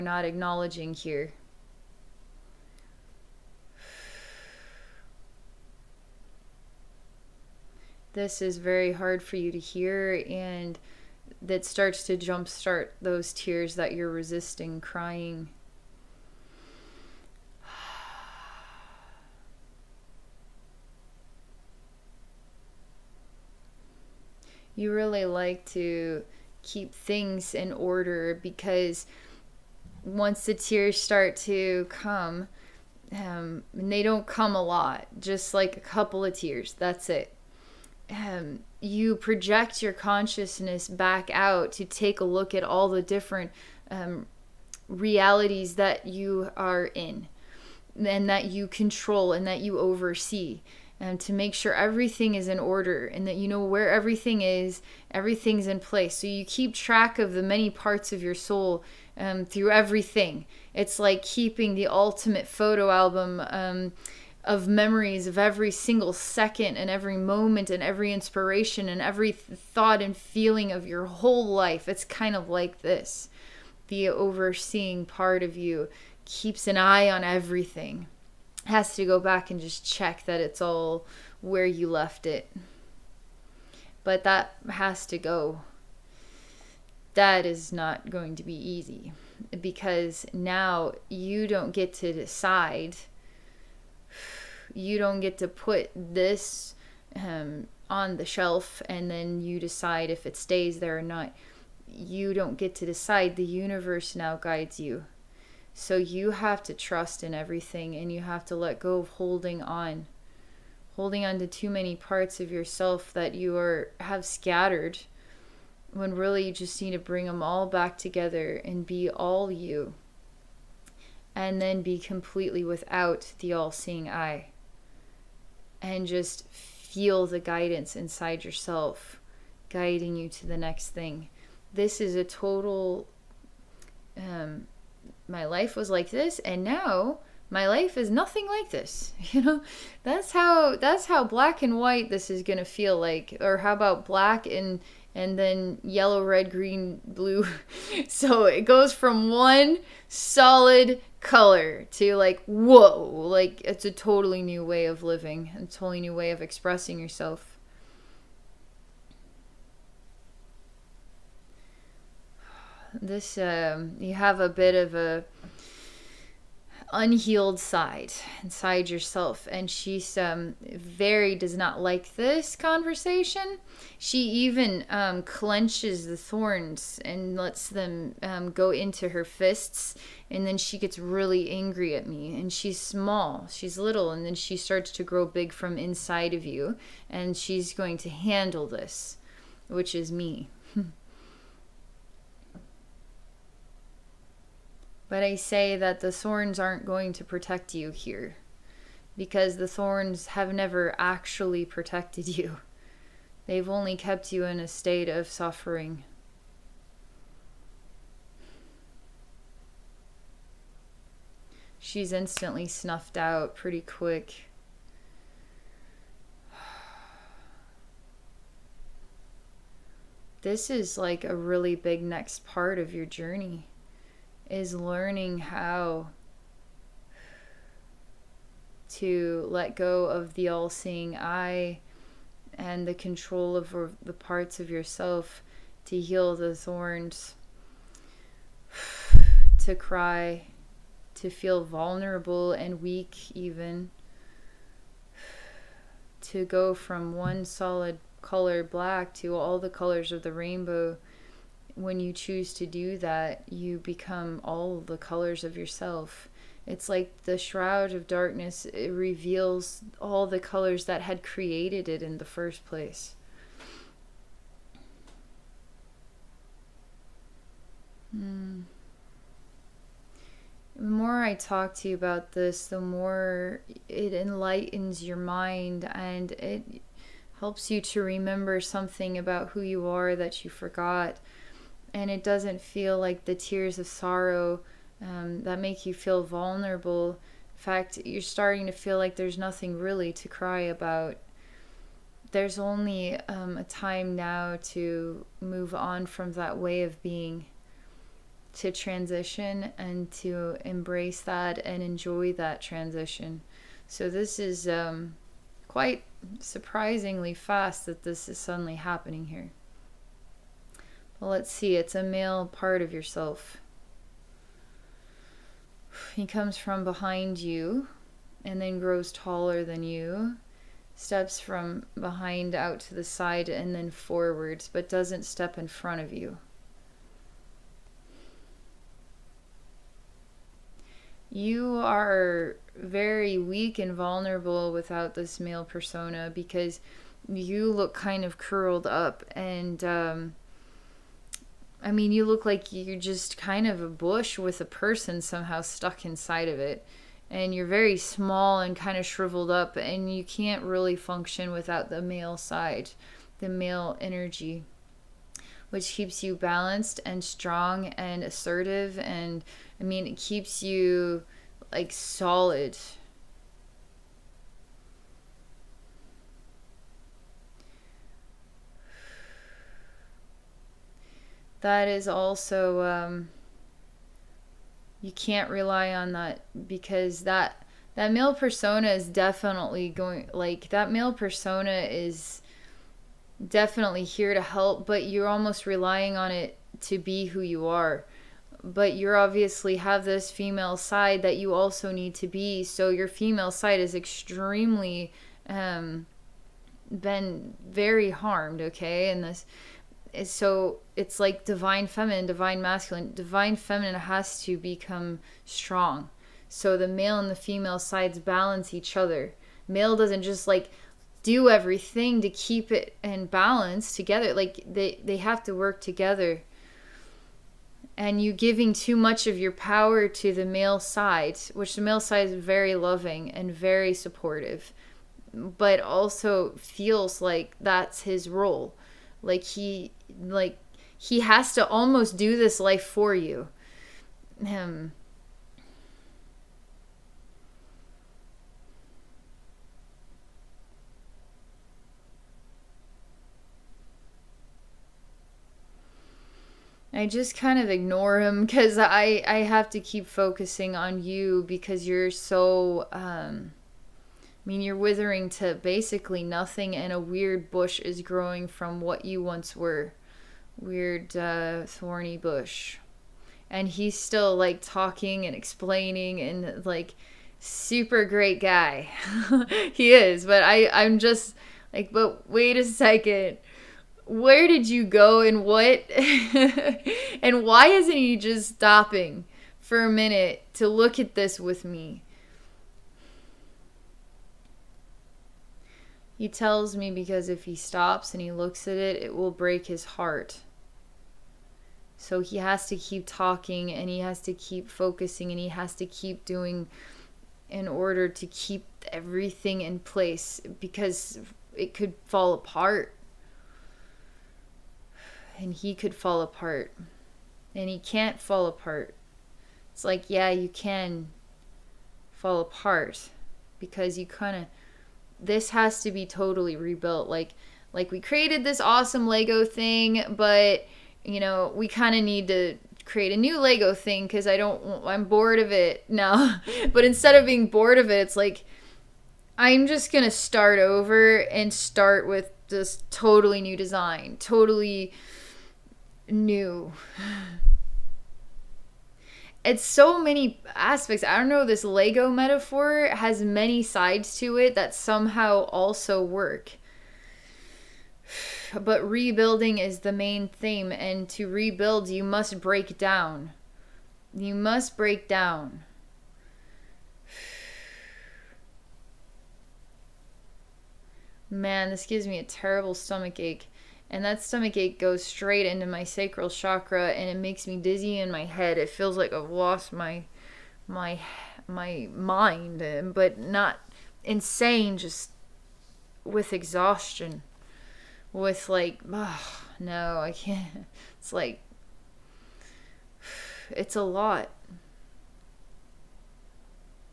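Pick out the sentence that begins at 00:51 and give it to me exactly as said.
And um, to make sure everything is in order and that you know where everything is, everything's in place.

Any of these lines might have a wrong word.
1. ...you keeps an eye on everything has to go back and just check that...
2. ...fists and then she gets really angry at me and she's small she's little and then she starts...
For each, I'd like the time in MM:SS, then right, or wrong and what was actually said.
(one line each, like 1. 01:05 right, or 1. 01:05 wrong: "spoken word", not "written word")
1. 01:15 right
2. 02:59 right.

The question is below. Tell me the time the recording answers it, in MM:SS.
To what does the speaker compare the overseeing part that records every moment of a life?
01:01.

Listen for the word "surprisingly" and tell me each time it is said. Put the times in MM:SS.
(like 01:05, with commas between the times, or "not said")
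05:06.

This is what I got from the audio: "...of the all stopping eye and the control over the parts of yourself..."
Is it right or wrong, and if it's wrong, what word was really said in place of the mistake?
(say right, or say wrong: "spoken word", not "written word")
wrong: "seeing", not "stopping".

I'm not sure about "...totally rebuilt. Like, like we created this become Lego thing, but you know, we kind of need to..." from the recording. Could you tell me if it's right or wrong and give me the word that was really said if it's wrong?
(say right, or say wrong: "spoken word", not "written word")
wrong: "awesome", not "become".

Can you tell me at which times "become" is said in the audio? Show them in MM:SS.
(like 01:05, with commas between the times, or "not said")
04:13, 06:44.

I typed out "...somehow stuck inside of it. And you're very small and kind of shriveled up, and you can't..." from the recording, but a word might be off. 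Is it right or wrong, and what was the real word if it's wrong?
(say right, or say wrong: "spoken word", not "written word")
right.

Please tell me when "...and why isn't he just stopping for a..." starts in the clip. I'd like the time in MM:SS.
07:57.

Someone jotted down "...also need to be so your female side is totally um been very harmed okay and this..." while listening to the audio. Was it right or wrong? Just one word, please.
wrong.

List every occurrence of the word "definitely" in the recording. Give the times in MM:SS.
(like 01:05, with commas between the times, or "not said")
06:19, 06:23.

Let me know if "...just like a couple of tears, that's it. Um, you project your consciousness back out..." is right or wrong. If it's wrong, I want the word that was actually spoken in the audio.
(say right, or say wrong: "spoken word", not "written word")
right.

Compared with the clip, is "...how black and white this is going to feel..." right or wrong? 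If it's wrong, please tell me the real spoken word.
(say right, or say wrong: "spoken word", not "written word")
right.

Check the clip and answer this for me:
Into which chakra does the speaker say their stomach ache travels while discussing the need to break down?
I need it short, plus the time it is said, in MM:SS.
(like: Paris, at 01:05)
Sacral chakra, at 09:25.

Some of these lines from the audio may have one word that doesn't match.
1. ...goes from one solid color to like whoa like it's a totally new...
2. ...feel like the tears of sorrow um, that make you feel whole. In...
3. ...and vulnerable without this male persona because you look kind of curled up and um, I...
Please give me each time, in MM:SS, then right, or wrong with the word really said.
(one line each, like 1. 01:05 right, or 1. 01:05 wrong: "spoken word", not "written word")
1. 02:28 right
2. 04:42 wrong: "vulnerable", not "whole"
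3. 05:33 right.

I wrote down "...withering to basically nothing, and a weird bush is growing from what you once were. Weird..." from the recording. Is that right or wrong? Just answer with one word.
right.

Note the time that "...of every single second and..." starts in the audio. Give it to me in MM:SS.
01:05.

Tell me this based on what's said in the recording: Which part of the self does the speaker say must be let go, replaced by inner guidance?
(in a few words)
The all-seeing eye.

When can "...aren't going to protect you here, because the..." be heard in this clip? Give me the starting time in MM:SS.
03:16.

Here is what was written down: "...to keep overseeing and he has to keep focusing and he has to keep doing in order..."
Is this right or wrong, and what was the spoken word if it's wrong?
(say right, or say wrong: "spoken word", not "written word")
wrong: "talking", not "overseeing".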